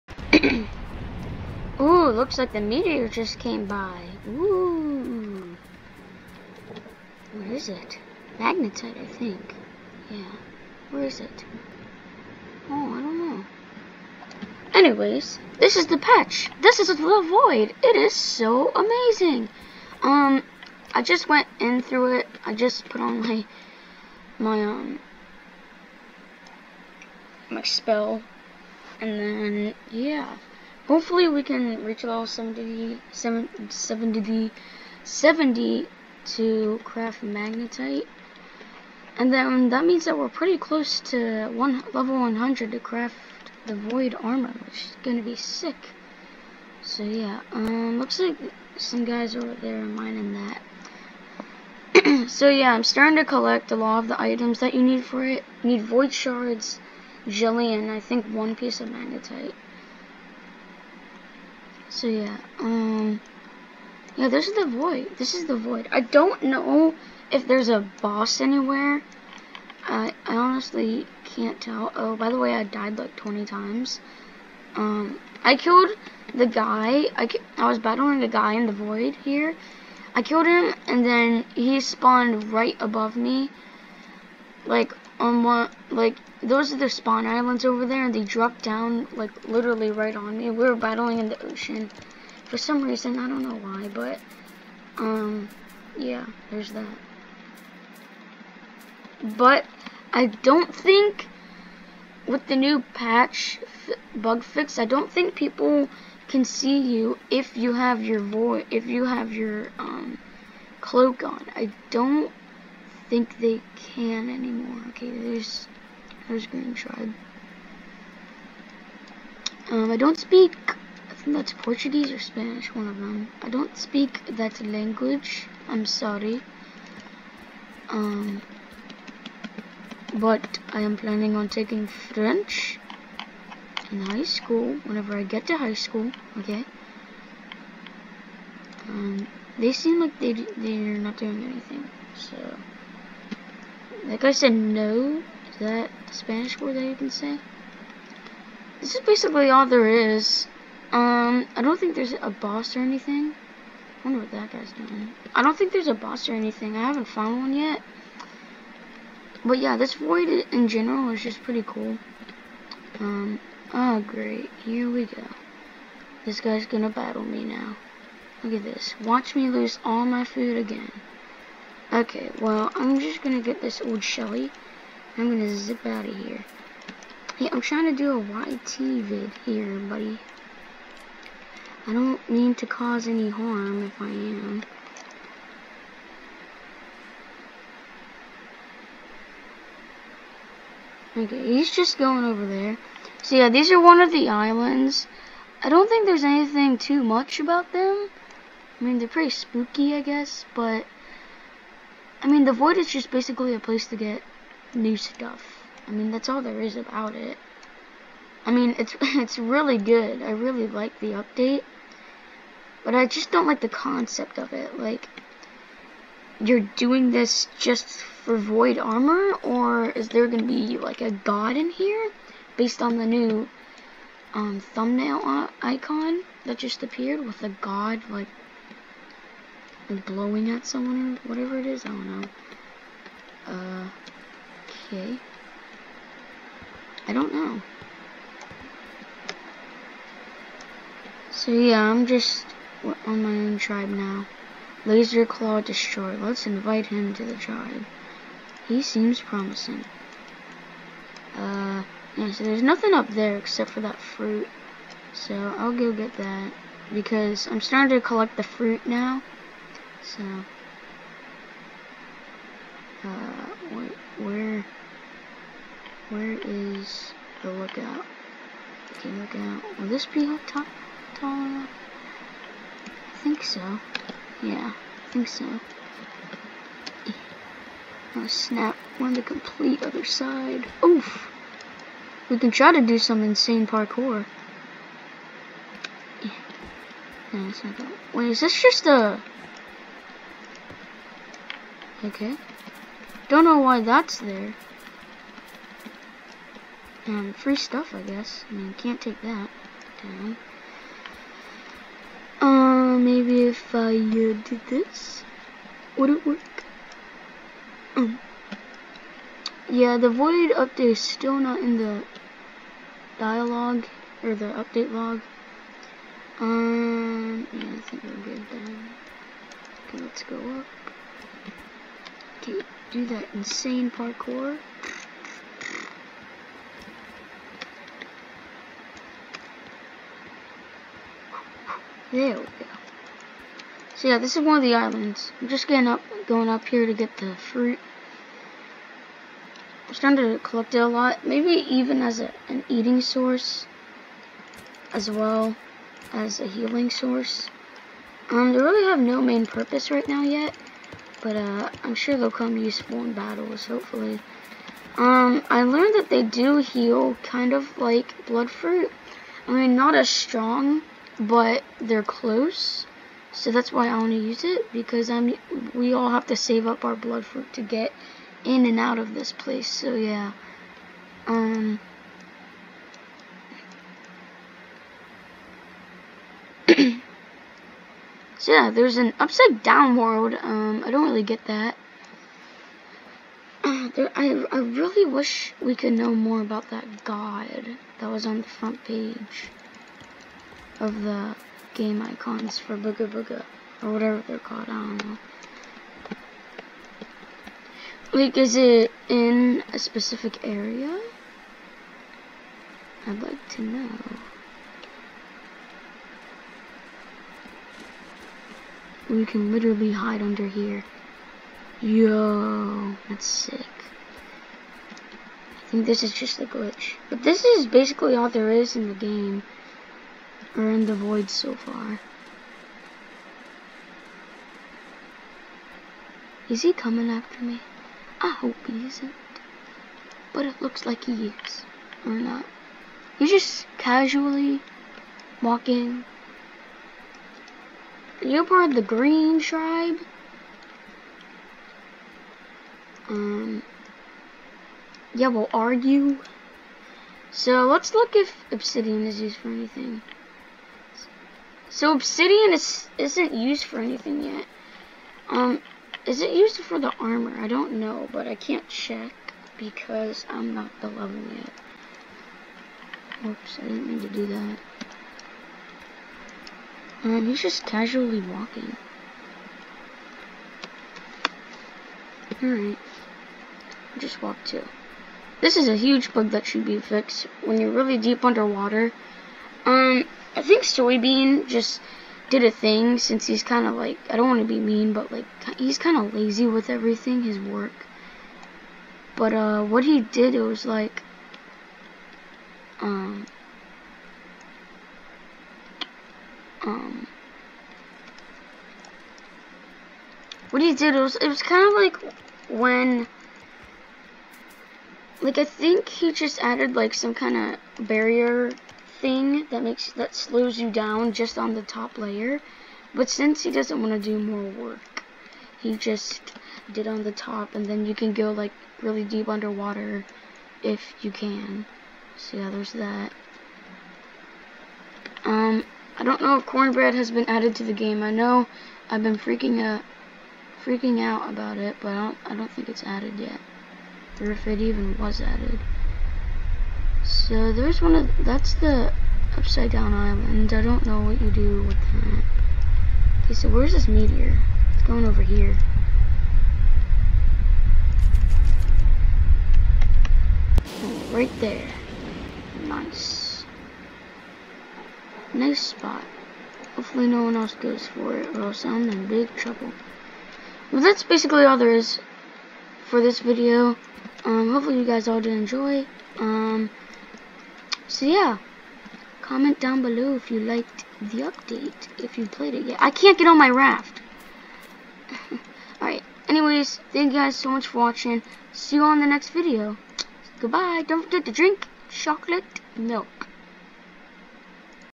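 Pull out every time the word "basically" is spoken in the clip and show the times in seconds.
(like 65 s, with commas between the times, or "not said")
149 s, 203 s, 417 s, 561 s.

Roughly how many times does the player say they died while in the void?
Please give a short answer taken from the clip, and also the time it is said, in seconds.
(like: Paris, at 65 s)
20, at 73 s.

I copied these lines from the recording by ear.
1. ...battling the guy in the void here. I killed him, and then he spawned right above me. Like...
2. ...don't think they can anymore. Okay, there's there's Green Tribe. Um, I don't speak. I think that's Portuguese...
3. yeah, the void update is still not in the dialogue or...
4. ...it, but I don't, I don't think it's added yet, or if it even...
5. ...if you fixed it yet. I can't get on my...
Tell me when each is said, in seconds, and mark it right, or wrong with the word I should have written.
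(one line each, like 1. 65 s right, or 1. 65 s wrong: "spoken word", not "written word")
1. 77 s right
2. 111 s right
3. 309 s right
4. 531 s right
5. 571 s wrong: "played", not "fixed".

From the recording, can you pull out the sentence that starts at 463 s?
Oops, I didn't mean to do that.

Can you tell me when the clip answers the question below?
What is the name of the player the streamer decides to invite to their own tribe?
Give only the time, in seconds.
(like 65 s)
244 s.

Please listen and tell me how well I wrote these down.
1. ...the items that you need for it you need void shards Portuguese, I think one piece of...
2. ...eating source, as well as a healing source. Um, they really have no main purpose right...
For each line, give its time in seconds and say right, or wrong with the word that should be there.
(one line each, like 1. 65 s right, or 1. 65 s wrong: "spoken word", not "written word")
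1. 54 s wrong: "Jillian", not "Portuguese"
2. 342 s right.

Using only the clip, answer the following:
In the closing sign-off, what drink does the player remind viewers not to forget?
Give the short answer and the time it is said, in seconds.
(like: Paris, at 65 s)
chocolate milk, at 581 s.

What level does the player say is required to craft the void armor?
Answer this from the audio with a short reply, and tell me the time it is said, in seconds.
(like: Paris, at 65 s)
100, at 41 s.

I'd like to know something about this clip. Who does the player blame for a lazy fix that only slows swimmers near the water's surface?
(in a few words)
Soybeen.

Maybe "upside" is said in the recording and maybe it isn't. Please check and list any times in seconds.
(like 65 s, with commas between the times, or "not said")
379 s, 539 s.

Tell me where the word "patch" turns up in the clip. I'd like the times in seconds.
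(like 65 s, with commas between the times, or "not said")
15 s, 102 s.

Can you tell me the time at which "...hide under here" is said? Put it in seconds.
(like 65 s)
409 s.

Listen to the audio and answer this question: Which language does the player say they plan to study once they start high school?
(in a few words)
French.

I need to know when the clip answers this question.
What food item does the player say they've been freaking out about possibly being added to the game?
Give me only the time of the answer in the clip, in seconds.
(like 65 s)
526 s.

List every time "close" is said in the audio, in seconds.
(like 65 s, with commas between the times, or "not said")
40 s, 362 s.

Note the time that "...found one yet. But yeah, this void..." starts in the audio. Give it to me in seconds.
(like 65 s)
157 s.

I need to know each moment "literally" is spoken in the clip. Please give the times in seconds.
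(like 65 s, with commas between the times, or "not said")
89 s, 409 s.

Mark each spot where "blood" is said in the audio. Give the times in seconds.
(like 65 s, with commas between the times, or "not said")
358 s, 366 s.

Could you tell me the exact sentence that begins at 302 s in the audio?
Uh, maybe if I uh, did this, would it work?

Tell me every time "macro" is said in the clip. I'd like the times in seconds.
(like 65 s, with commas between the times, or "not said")
not said.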